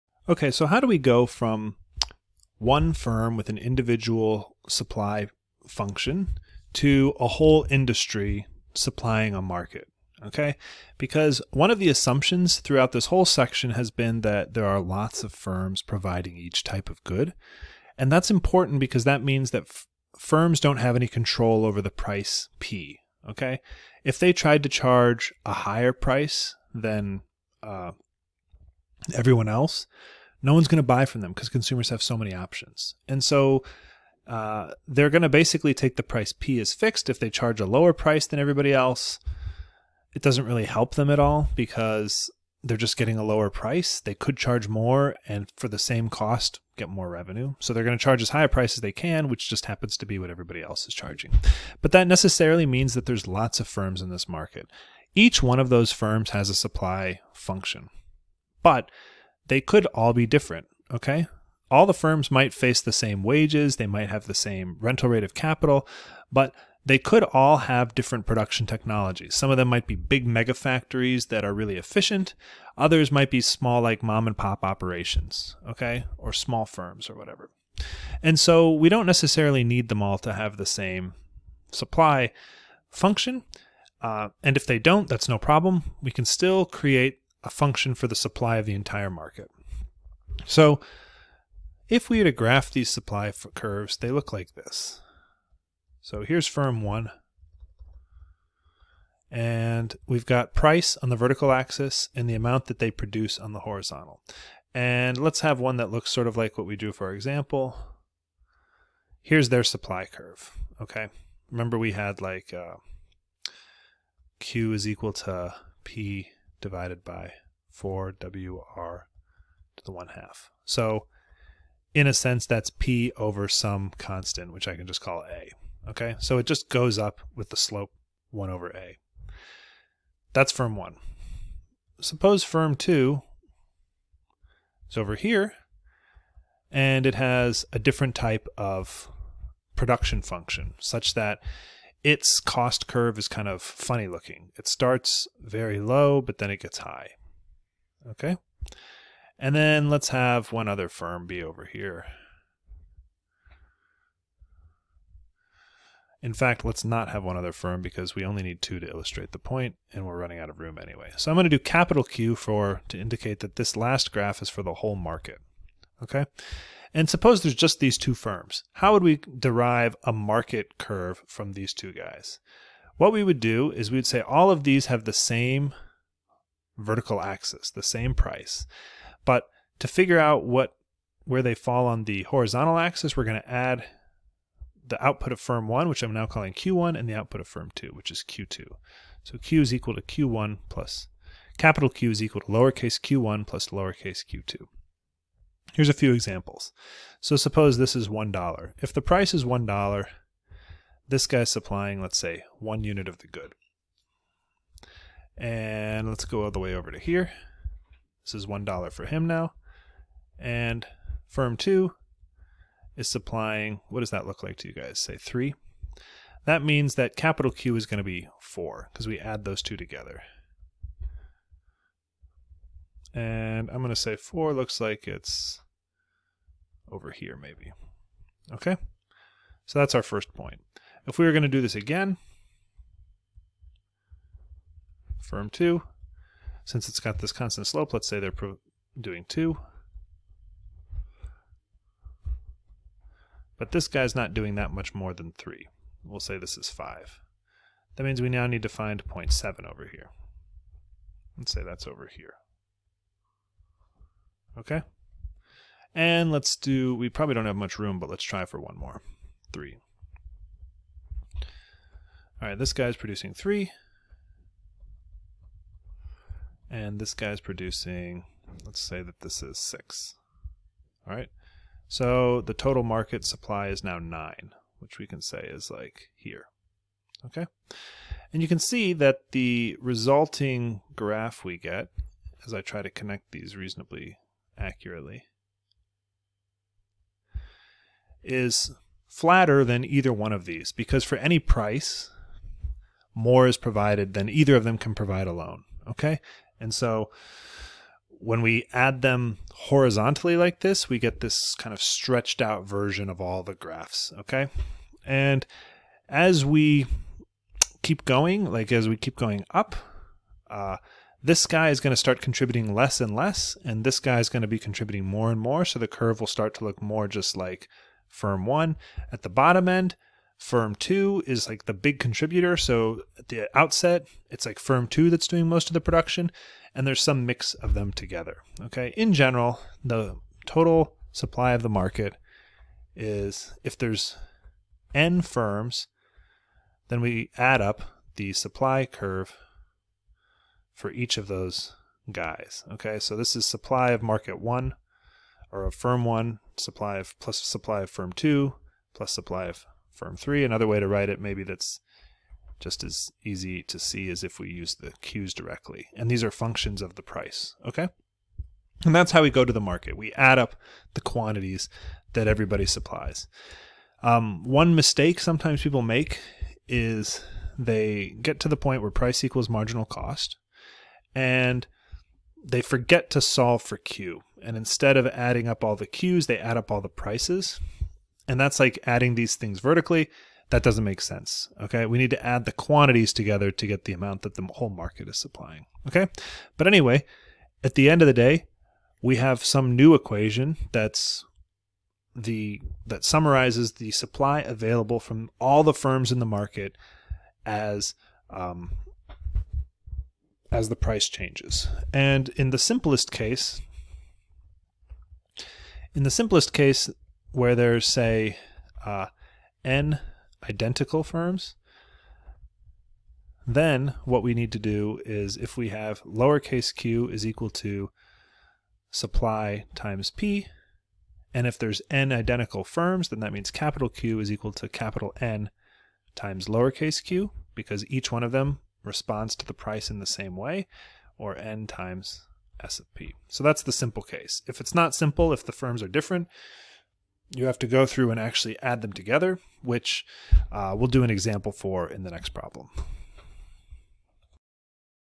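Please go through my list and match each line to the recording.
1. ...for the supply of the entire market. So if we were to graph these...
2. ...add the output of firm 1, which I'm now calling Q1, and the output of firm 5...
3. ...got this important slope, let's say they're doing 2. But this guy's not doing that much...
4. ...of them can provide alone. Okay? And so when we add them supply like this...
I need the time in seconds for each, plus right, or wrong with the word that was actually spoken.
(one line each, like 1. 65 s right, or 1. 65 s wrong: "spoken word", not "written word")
1. 87 s right
2. 183 s wrong: "2", not "5"
3. 236 s wrong: "constant", not "important"
4. 294 s wrong: "horizontally", not "supply".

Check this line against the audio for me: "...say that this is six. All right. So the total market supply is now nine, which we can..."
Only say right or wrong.
right.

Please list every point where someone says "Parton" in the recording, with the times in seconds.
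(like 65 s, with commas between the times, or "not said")
not said.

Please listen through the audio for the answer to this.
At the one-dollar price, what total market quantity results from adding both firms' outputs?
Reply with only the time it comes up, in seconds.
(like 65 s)
217 s.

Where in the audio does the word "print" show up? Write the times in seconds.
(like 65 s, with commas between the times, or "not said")
not said.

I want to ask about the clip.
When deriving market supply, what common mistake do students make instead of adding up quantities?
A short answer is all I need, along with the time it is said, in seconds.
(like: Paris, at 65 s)
add up all the prices, at 376 s.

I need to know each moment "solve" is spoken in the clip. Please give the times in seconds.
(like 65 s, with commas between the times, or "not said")
373 s.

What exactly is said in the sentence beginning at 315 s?
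So the curve will start to look more just like firm one.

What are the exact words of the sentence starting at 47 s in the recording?
So they're going to charge as high a price as they can, which just happens to be what everybody else is charging.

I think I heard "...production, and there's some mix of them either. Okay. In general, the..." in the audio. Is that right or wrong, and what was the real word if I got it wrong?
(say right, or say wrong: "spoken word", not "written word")
wrong: "together", not "either".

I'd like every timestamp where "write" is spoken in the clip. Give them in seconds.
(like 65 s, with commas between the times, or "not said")
350 s.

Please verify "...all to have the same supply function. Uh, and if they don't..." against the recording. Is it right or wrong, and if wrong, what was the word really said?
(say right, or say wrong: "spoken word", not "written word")
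right.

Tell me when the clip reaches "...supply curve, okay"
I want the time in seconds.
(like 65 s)
109 s.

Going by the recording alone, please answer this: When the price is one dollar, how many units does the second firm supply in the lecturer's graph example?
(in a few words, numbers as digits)
3.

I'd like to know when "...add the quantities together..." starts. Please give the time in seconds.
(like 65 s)
382 s.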